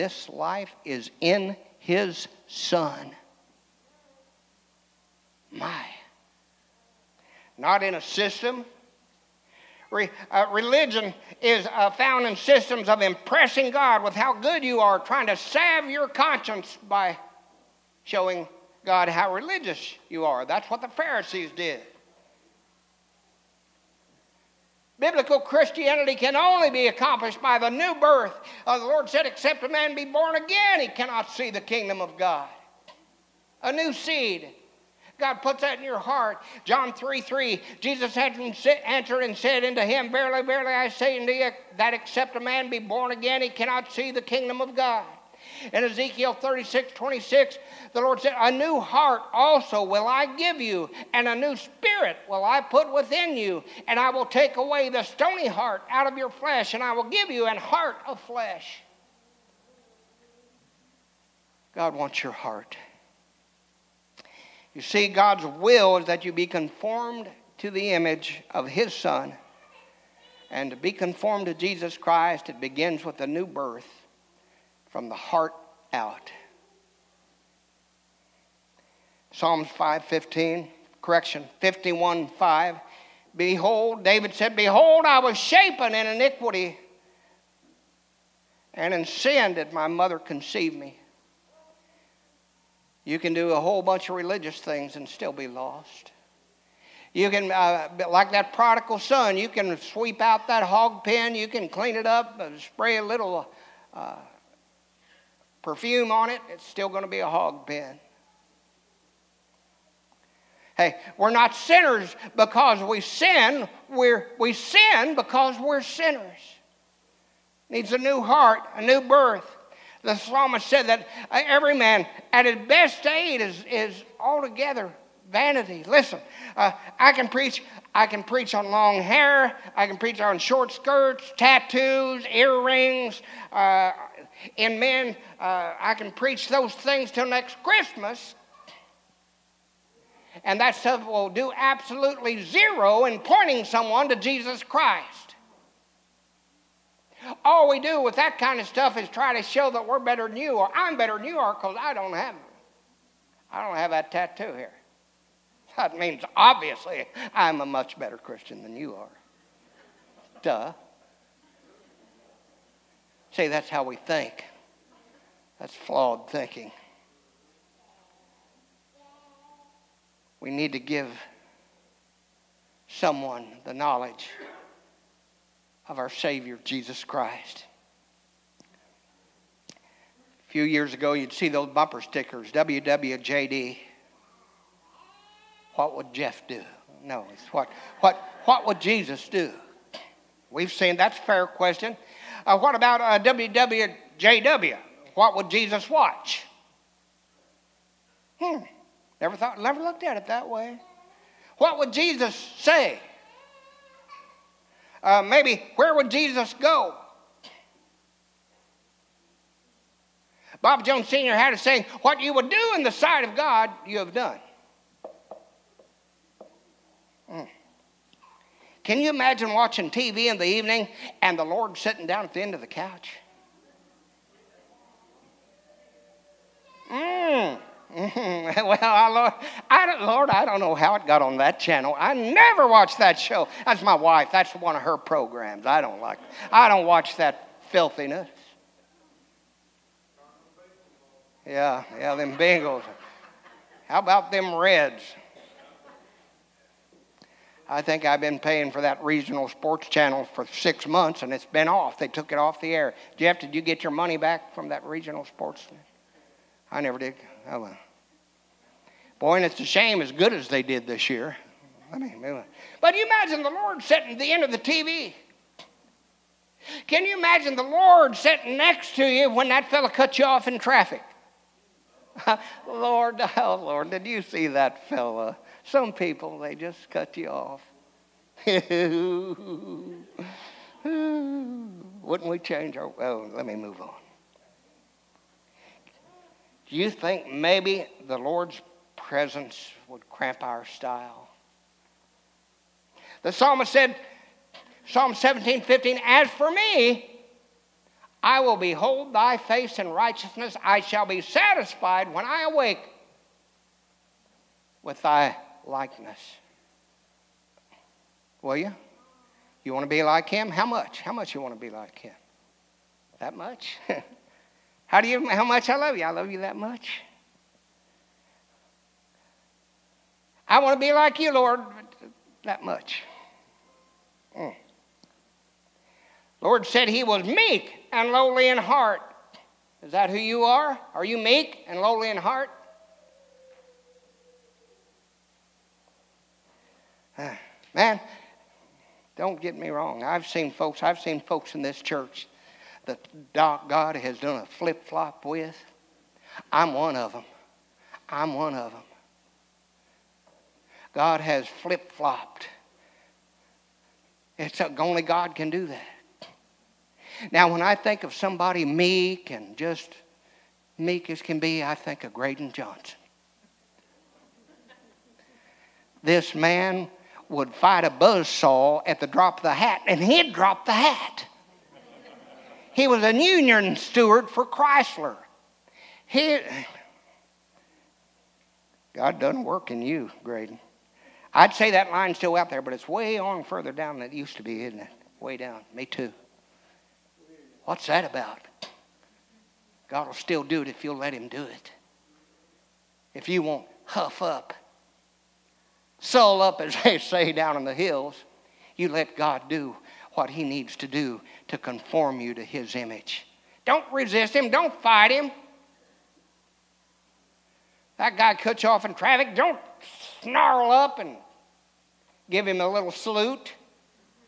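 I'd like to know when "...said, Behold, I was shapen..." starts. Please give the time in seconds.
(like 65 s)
84 s.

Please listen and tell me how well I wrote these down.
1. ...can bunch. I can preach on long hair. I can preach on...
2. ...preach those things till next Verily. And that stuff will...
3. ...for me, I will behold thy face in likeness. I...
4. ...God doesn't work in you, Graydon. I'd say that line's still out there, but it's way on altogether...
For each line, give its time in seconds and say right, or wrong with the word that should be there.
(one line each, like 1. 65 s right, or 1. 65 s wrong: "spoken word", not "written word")
1. 127 s wrong: "preach", not "bunch"
2. 136 s wrong: "Christmas", not "Verily"
3. 296 s wrong: "righteousness", not "likeness"
4. 378 s wrong: "further", not "altogether".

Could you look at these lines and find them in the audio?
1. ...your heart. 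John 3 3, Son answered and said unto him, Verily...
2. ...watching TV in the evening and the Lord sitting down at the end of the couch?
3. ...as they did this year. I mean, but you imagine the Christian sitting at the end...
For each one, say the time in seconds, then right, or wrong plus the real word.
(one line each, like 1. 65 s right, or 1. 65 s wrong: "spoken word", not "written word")
1. 35 s wrong: "Jesus", not "Son"
2. 219 s right
3. 260 s wrong: "Lord", not "Christian".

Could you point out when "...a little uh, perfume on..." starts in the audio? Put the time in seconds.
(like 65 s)
102 s.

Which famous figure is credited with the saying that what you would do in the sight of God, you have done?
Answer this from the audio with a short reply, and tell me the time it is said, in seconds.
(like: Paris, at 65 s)
Bob Jones Sr., at 210 s.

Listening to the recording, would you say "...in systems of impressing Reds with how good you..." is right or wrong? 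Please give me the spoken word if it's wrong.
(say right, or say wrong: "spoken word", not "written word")
wrong: "God", not "Reds".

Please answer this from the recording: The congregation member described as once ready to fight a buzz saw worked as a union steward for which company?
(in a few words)
Chrysler.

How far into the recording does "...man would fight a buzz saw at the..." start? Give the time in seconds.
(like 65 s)
366 s.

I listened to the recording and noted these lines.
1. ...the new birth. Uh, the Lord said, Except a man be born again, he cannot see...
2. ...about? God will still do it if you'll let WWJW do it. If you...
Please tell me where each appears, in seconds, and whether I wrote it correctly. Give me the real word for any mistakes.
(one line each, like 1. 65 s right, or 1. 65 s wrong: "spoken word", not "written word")
1. 27 s right
2. 388 s wrong: "Him", not "WWJW".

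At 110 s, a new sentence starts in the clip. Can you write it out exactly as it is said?
Hey, we're not sinners because we sin, we're, we sin because we're sinners.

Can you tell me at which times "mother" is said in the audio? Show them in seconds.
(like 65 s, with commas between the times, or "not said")
89 s.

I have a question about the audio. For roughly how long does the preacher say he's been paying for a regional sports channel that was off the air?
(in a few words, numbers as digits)
6 months.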